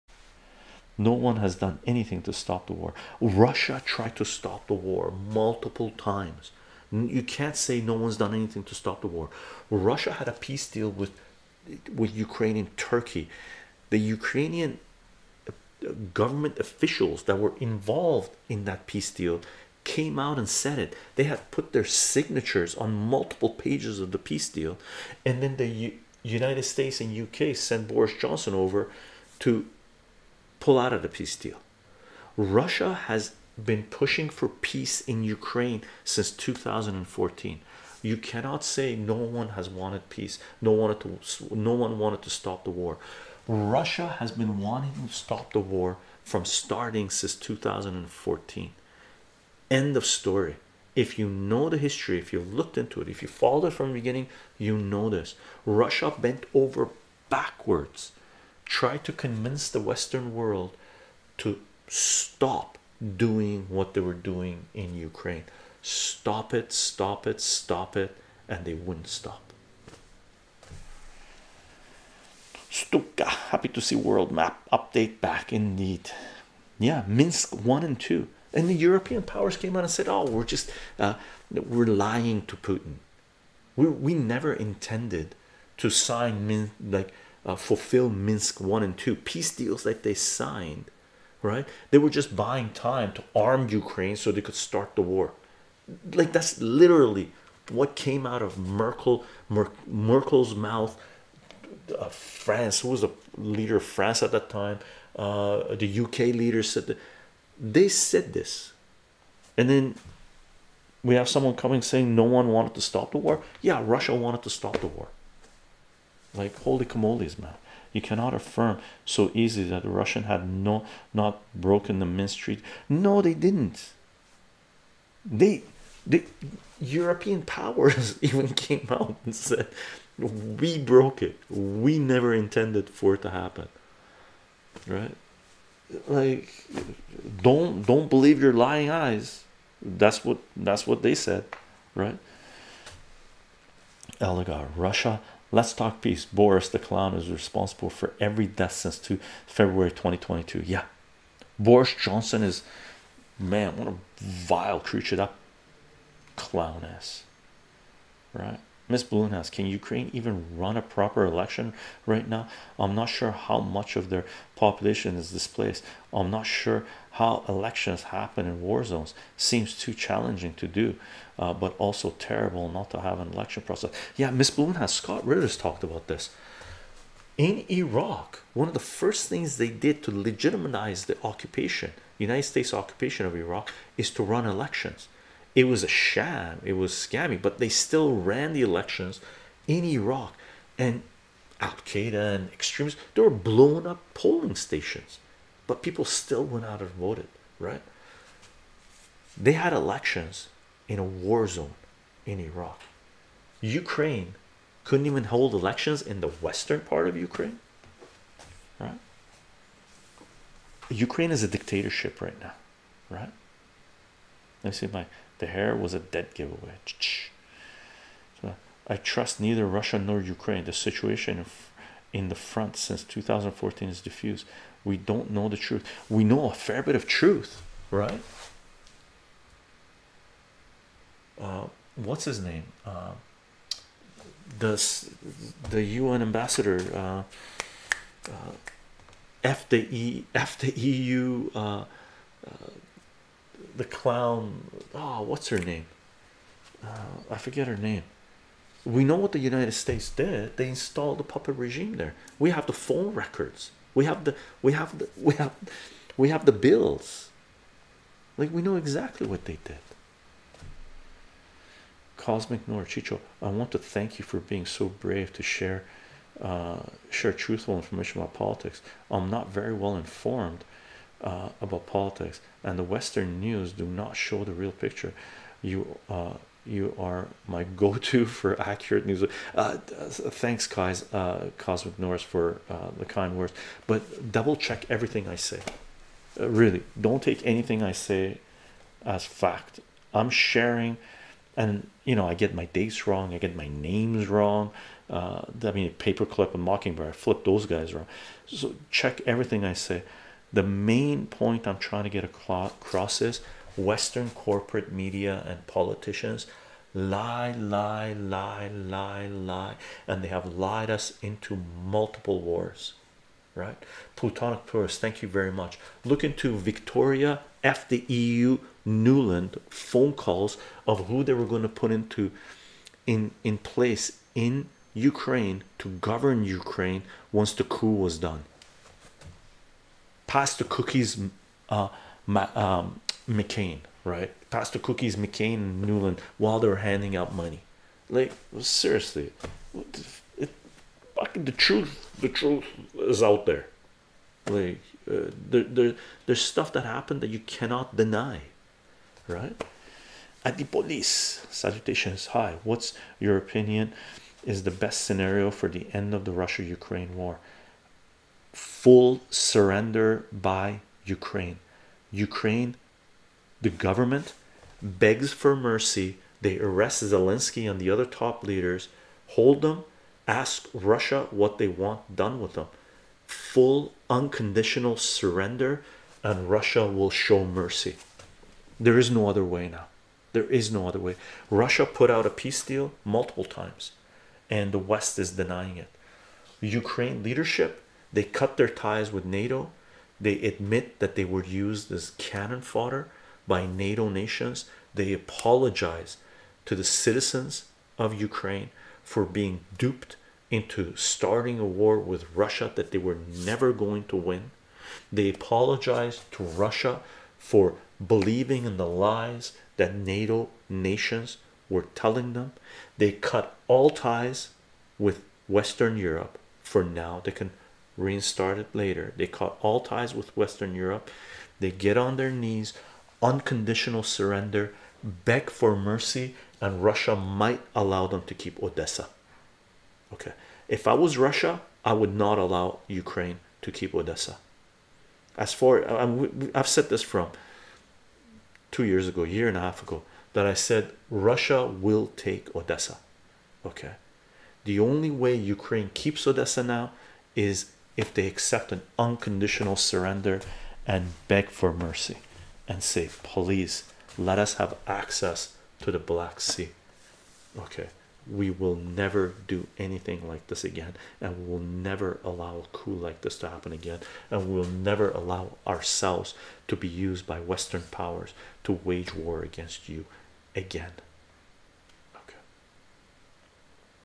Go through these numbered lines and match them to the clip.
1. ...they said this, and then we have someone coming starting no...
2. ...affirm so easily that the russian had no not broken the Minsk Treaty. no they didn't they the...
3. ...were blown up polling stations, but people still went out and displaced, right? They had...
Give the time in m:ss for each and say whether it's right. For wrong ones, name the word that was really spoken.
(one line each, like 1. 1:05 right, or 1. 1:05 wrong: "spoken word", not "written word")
1. 1:47 wrong: "saying", not "starting"
2. 1:58 right
3. 3:13 wrong: "voted", not "displaced".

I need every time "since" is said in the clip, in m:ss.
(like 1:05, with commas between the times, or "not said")
0:36, 0:47, 2:28, 3:42.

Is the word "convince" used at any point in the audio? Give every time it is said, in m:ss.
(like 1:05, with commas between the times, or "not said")
0:59.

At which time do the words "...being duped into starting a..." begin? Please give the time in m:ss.
6:39.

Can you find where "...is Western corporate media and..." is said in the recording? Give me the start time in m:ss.
5:03.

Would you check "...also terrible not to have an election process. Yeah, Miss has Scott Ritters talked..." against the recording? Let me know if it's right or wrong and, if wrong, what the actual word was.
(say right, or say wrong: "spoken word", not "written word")
right.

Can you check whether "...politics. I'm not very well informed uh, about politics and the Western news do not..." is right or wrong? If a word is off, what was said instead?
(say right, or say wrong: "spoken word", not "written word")
right.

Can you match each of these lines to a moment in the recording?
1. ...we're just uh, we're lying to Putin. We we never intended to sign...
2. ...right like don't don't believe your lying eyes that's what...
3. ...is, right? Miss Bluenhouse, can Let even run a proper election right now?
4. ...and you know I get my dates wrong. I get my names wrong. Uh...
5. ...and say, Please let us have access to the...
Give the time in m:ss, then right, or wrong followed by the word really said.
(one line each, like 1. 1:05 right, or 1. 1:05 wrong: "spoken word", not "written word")
1. 1:20 right
2. 2:14 right
3. 2:36 wrong: "Ukraine", not "Let"
4. 4:51 right
5. 7:32 right.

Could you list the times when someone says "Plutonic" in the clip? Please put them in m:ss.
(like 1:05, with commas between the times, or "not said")
5:14.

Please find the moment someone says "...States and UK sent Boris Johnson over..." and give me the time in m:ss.
0:26.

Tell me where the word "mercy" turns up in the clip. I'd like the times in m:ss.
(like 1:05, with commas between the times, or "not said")
6:05, 6:17, 7:05, 7:31.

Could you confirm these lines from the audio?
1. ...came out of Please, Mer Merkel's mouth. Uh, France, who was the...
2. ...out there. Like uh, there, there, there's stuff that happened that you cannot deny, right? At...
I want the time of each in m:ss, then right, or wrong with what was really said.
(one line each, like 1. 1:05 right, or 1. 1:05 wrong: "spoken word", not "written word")
1. 1:37 wrong: "Merkel", not "Please"
2. 5:43 right.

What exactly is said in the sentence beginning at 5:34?
Pastor Cookies McCain and Nuland while they were handing out money.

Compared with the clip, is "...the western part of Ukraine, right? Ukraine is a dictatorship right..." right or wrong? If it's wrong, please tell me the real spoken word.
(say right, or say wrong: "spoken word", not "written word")
right.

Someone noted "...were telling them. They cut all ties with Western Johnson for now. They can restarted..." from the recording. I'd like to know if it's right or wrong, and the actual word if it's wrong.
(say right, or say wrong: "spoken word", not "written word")
wrong: "Europe", not "Johnson".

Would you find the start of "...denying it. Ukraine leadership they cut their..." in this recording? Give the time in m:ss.
6:25.